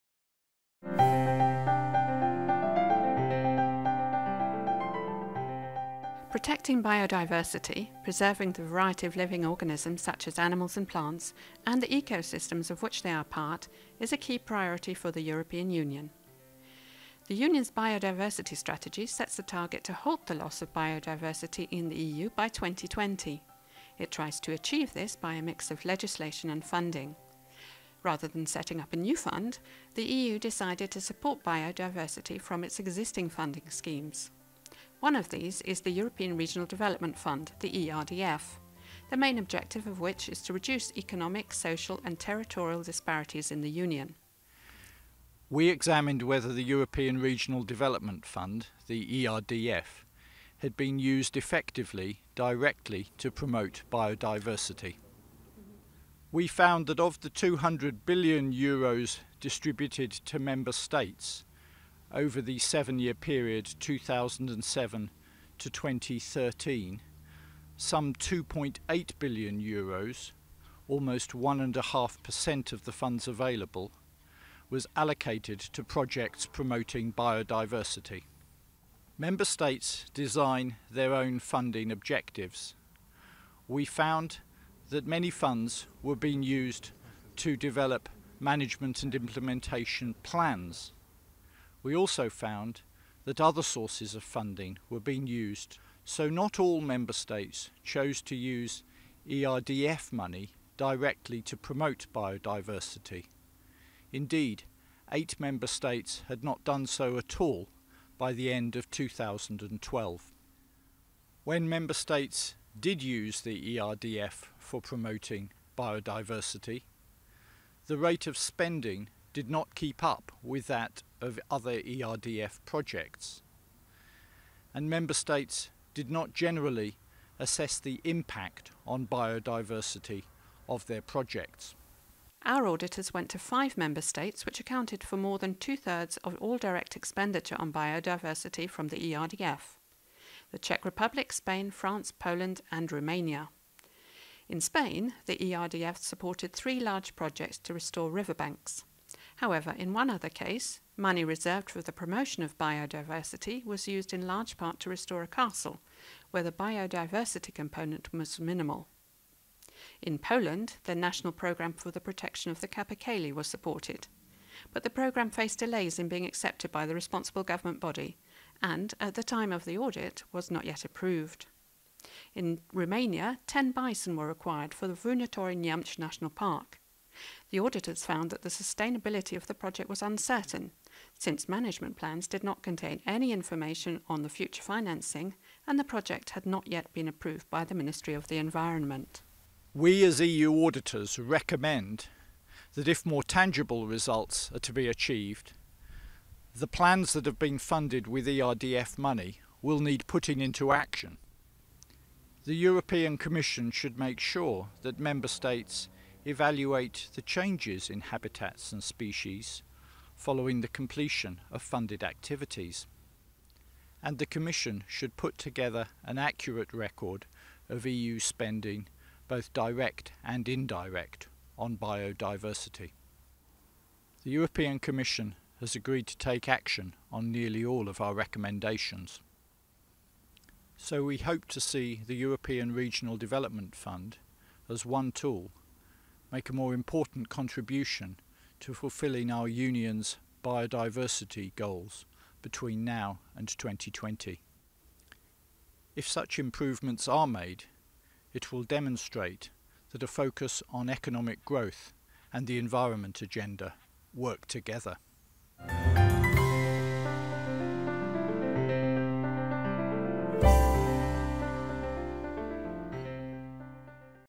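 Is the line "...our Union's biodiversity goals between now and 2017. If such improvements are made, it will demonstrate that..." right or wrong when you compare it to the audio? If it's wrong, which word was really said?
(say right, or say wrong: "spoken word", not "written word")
wrong: "2020", not "2017".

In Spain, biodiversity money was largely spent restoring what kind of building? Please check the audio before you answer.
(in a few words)
A castle.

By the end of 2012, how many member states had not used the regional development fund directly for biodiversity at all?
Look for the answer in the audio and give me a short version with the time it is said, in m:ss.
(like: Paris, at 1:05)
8, at 1:45.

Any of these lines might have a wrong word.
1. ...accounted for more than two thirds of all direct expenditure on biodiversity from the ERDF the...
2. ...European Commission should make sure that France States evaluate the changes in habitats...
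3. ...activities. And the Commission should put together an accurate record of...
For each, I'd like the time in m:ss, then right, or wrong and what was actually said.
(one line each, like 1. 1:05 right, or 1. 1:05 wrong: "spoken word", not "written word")
1. 2:14 right
2. 3:22 wrong: "Member", not "France"
3. 3:32 right.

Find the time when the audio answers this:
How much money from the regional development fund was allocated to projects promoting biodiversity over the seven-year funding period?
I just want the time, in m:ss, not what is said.
1:08.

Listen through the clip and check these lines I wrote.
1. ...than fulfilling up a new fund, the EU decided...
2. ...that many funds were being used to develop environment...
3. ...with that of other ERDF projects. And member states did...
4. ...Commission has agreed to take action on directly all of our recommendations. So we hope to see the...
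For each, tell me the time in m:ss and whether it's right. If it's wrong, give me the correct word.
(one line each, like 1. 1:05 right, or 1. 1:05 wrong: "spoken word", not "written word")
1. 0:28 wrong: "setting", not "fulfilling"
2. 1:24 wrong: "management", not "environment"
3. 2:00 right
4. 3:44 wrong: "nearly", not "directly".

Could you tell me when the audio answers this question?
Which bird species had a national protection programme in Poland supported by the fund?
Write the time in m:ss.
2:42.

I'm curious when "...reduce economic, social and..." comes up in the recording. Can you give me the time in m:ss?
0:40.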